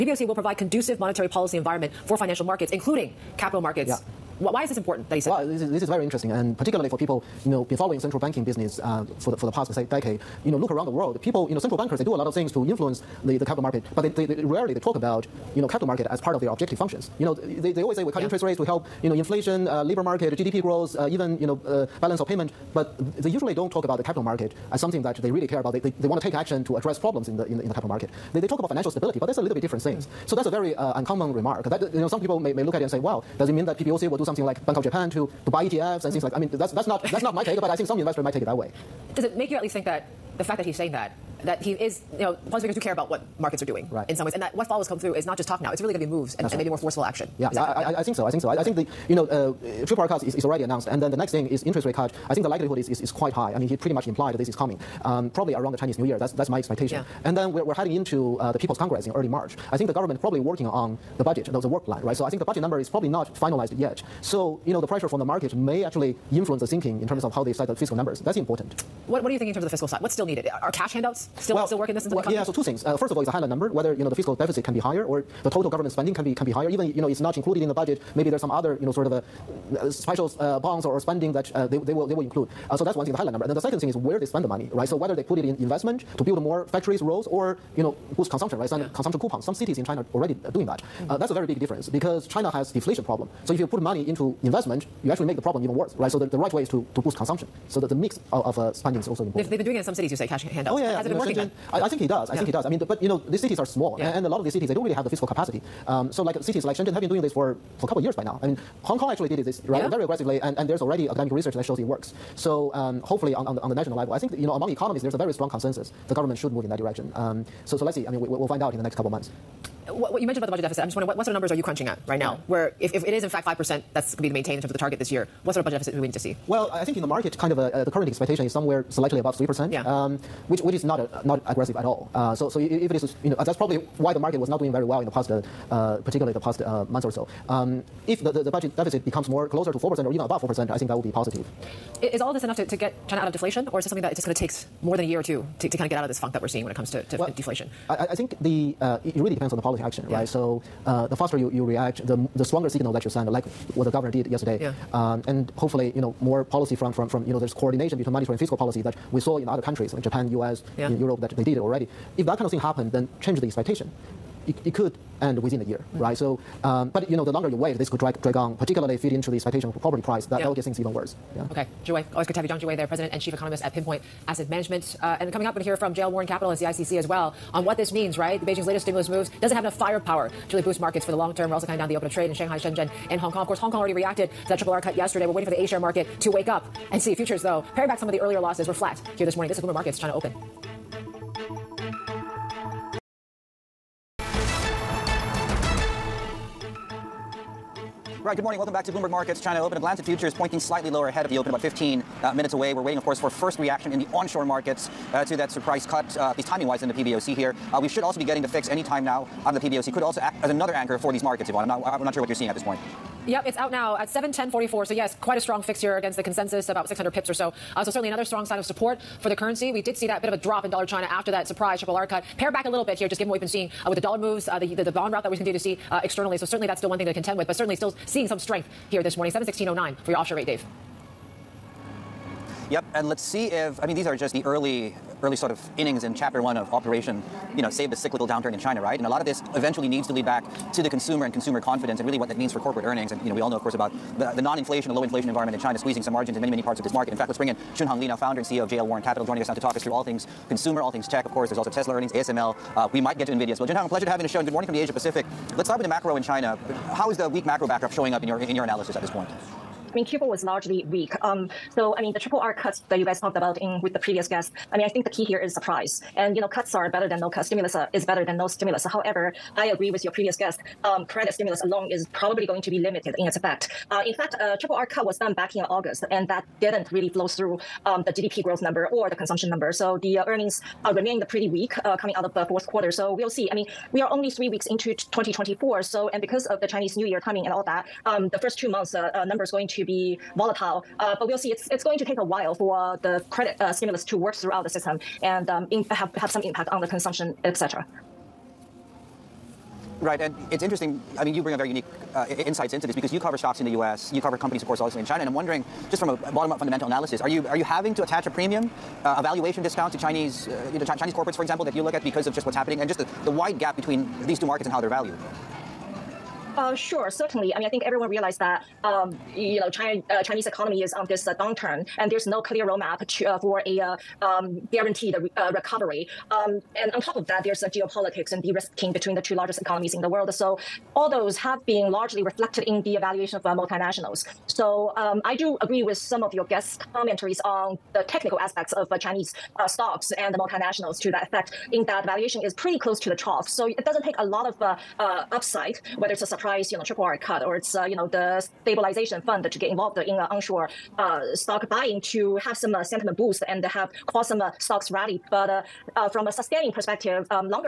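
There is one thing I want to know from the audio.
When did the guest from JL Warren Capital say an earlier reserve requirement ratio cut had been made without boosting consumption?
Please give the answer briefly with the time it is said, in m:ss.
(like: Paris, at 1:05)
August, at 4:35.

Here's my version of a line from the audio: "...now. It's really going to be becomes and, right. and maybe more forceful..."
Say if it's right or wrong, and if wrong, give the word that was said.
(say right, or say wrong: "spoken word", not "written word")
wrong: "moves", not "becomes".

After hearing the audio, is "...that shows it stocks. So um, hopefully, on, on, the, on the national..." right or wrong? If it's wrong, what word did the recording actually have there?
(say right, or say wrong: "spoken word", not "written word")
wrong: "works", not "stocks".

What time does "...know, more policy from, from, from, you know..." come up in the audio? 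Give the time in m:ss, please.
2:36.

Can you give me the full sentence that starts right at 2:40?
in Europe, that they did it already.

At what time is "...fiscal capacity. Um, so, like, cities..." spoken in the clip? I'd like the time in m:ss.
1:45.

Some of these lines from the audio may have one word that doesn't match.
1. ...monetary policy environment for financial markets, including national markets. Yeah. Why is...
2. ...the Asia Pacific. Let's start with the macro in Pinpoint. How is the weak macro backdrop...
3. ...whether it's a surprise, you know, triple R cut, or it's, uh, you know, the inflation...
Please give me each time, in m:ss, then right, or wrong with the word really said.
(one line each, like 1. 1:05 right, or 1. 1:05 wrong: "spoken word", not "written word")
1. 0:00 wrong: "capital", not "national"
2. 4:14 wrong: "China", not "Pinpoint"
3. 5:45 wrong: "stabilization", not "inflation".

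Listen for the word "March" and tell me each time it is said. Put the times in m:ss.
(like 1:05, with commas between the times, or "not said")
0:59.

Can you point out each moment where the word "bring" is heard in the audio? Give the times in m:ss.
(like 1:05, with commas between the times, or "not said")
4:07, 5:01.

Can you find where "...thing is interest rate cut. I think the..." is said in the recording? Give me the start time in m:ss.
0:51.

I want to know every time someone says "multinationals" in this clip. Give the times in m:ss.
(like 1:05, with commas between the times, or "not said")
5:33, 5:40.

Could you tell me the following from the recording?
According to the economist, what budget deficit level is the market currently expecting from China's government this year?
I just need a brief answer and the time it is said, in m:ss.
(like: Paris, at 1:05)
slightly above 3%, at 2:08.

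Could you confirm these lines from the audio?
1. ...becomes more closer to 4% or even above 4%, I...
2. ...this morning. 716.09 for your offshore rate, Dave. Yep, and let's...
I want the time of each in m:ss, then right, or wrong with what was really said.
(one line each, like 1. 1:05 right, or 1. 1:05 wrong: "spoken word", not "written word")
1. 2:19 right
2. 3:49 right.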